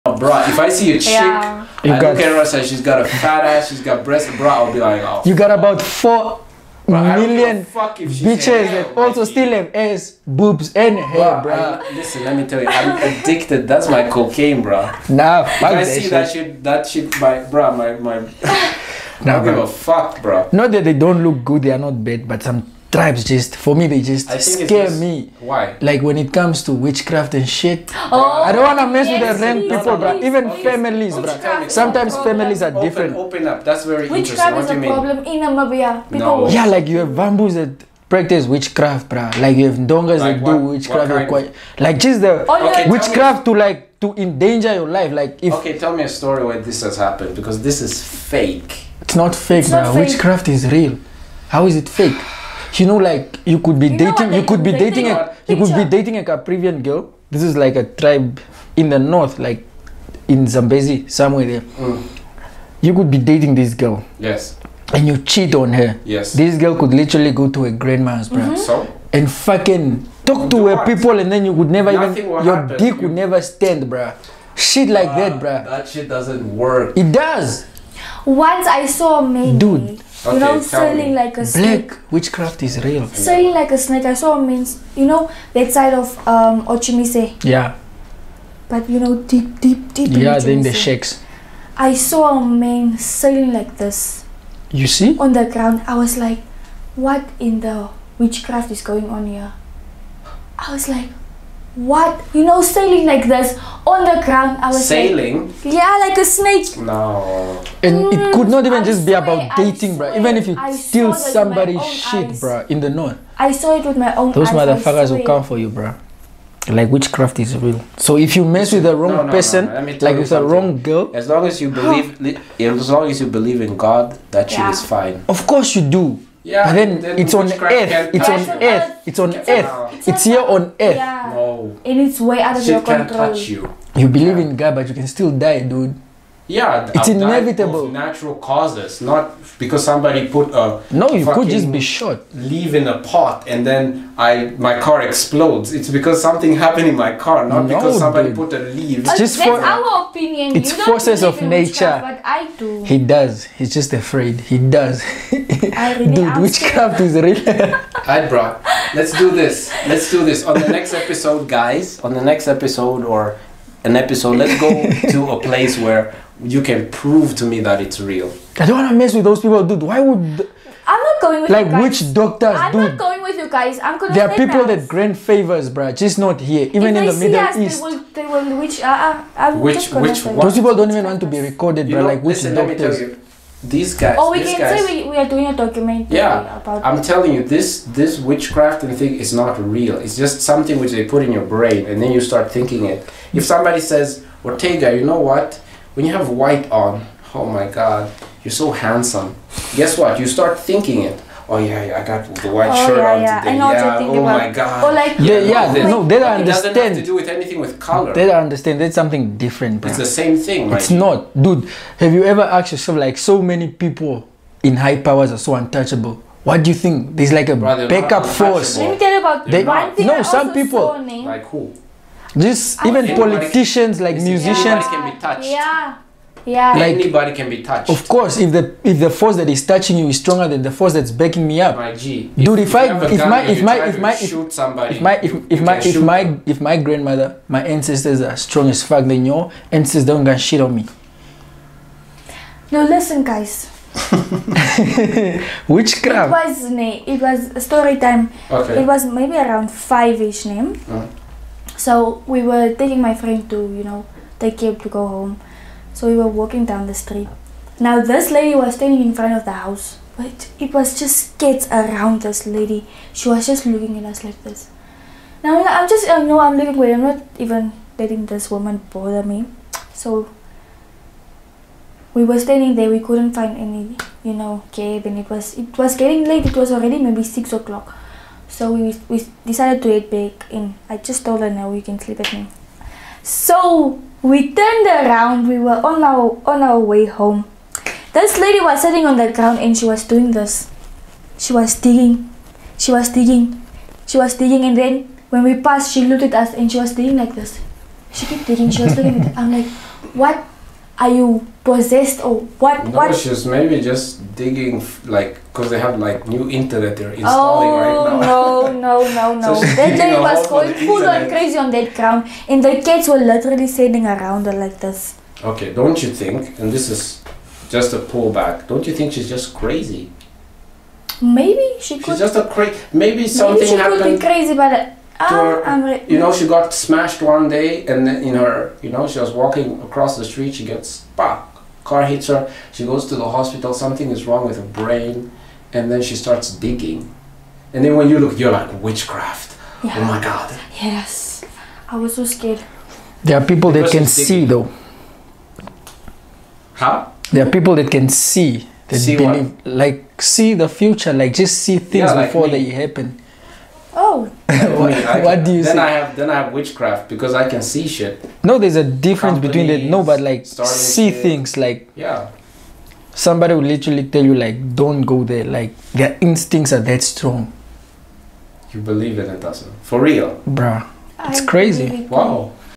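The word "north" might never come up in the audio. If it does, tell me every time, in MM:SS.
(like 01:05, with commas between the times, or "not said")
00:58, 01:52.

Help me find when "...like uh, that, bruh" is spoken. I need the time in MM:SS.
01:14.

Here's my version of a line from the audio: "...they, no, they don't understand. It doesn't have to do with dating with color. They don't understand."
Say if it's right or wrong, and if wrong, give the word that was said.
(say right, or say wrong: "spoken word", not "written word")
wrong: "anything", not "dating".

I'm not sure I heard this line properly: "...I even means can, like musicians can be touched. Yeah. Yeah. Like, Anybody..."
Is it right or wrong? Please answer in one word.
wrong.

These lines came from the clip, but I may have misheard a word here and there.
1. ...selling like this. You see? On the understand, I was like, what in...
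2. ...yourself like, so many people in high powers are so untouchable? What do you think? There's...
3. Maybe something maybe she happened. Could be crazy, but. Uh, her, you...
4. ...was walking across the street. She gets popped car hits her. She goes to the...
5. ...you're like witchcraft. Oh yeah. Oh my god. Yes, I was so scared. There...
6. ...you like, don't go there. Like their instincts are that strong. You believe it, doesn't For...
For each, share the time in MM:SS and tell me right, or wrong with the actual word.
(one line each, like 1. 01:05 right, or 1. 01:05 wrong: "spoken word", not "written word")
1. 01:32 wrong: "ground", not "understand"
2. 03:32 right
3. 05:22 right
4. 05:29 right
5. 05:38 right
6. 06:04 right.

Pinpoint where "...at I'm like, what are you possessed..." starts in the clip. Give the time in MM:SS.
04:59.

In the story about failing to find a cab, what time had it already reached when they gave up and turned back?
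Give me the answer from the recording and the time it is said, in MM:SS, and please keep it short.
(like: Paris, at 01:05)
6 o'clock, at 04:37.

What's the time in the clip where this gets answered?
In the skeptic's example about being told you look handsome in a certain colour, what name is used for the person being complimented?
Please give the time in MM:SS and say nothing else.
03:14.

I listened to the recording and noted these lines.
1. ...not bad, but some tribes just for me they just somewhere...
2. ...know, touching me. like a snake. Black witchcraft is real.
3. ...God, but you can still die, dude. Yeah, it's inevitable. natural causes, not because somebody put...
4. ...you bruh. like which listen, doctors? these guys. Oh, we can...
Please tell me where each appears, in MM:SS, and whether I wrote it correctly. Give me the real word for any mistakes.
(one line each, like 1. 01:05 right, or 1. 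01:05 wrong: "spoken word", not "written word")
1. 00:21 wrong: "scare", not "somewhere"
2. 01:20 wrong: "selling", not "touching"
3. 02:14 right
4. 03:01 right.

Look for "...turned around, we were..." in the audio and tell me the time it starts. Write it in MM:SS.
04:44.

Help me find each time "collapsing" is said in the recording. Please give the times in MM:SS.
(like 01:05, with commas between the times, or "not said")
not said.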